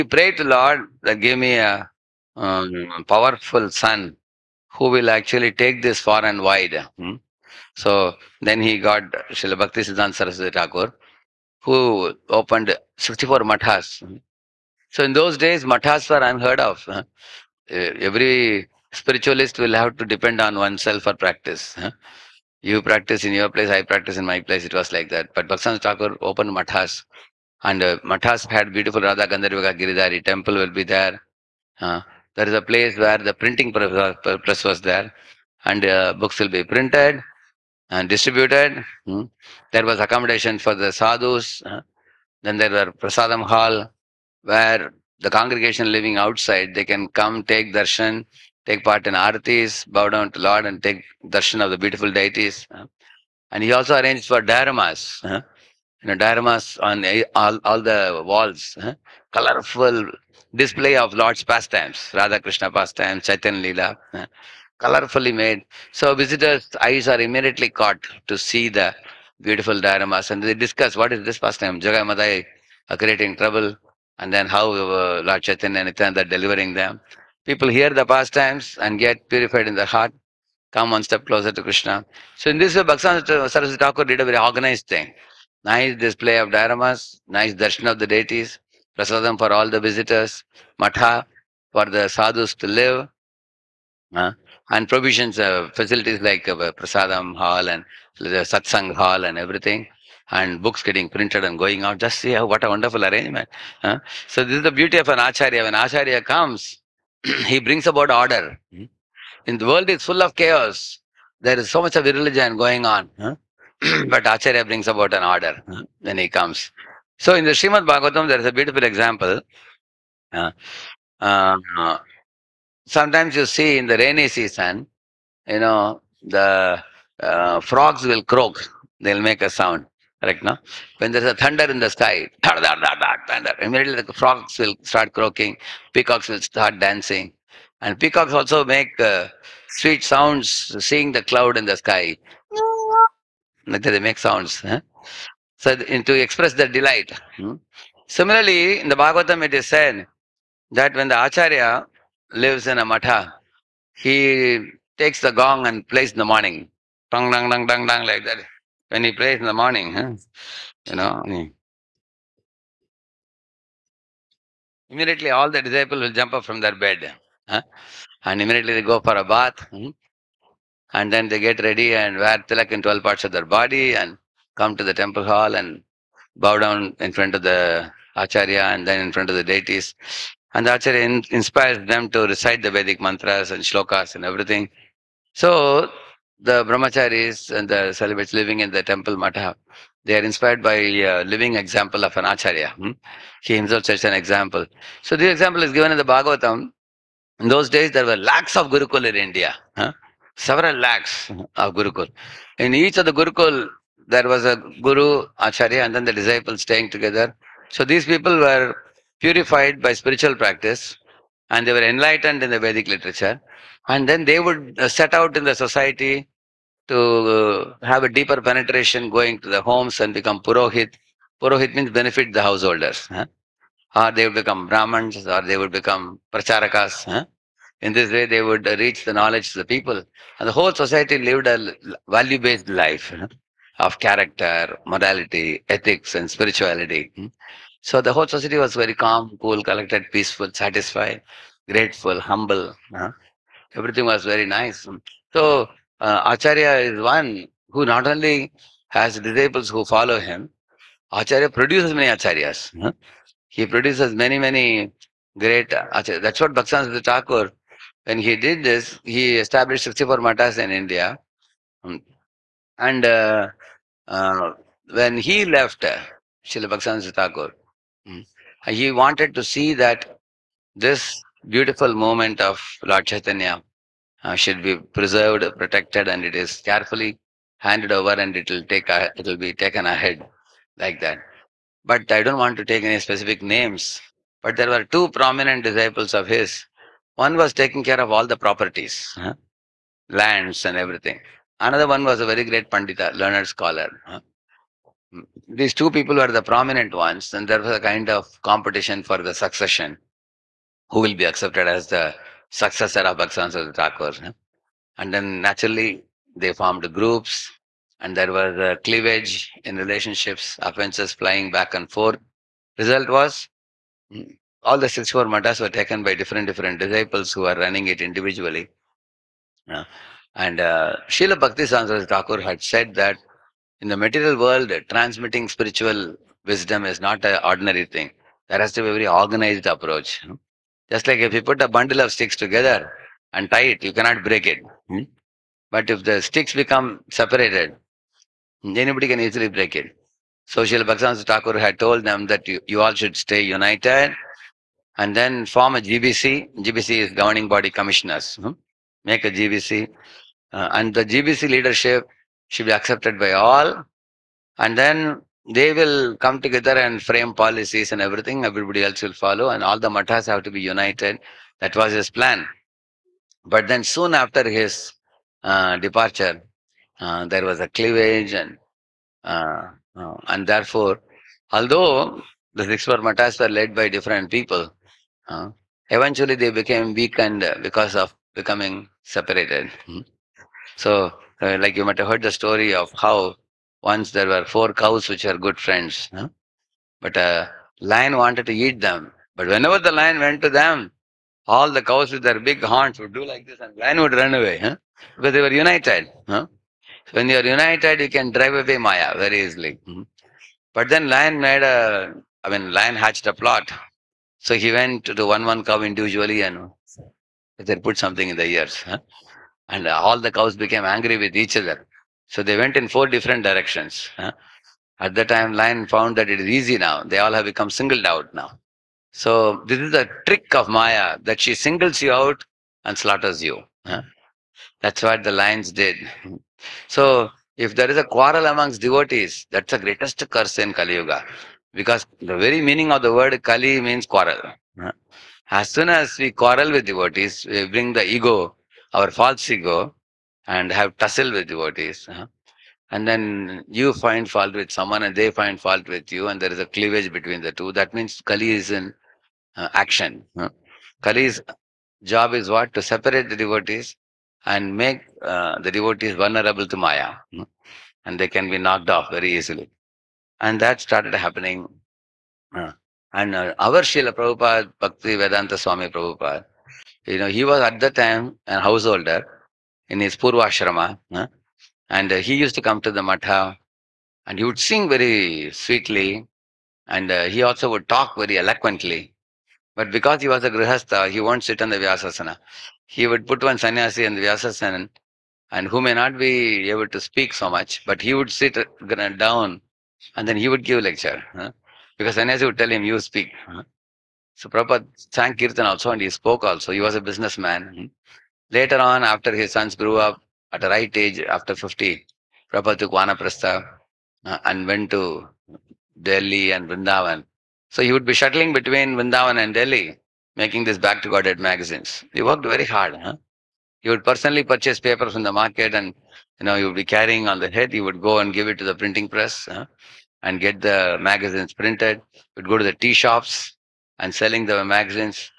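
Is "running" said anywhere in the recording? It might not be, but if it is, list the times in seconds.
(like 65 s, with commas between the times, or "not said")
317 s.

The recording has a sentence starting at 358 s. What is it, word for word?
Everybody else will follow, and all the matas have to be united.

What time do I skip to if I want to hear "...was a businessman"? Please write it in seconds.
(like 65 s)
496 s.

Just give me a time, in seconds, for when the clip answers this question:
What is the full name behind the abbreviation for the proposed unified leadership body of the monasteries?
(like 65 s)
347 s.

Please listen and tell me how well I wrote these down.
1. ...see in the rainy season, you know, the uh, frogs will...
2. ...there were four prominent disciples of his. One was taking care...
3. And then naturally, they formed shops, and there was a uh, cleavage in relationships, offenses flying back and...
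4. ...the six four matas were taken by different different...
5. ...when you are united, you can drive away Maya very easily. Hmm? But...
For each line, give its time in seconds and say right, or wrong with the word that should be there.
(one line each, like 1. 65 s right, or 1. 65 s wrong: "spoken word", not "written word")
1. 123 s right
2. 284 s wrong: "two", not "four"
3. 304 s wrong: "groups", not "shops"
4. 314 s right
5. 397 s right.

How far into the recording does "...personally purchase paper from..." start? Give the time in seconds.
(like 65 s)
514 s.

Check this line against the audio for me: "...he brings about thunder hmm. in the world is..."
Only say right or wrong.
wrong.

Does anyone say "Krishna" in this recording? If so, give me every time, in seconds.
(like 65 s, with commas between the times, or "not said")
62 s, 81 s.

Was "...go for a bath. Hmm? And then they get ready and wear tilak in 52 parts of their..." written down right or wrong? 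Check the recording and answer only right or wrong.
wrong.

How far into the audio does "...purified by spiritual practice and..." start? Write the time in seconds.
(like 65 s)
209 s.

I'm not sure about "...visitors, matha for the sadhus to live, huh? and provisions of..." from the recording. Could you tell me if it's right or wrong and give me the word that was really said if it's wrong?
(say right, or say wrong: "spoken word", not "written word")
right.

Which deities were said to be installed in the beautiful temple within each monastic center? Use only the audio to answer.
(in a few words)
Radha Gandharvika Giridhari.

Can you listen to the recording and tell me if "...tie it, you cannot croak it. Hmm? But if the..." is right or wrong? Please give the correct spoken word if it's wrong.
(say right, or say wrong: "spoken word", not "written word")
wrong: "break", not "croak".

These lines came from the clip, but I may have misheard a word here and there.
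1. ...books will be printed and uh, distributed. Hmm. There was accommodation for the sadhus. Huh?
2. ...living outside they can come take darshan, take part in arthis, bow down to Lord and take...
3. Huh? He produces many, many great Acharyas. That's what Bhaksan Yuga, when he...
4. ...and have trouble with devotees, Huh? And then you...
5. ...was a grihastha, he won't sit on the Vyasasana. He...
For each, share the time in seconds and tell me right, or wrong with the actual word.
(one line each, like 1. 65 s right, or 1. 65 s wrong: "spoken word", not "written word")
1. 36 s right
2. 45 s right
3. 252 s wrong: "Thakur", not "Yuga"
4. 440 s wrong: "tussle", not "trouble"
5. 480 s right.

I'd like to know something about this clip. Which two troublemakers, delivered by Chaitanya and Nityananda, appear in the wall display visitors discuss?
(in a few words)
Jagai Madai.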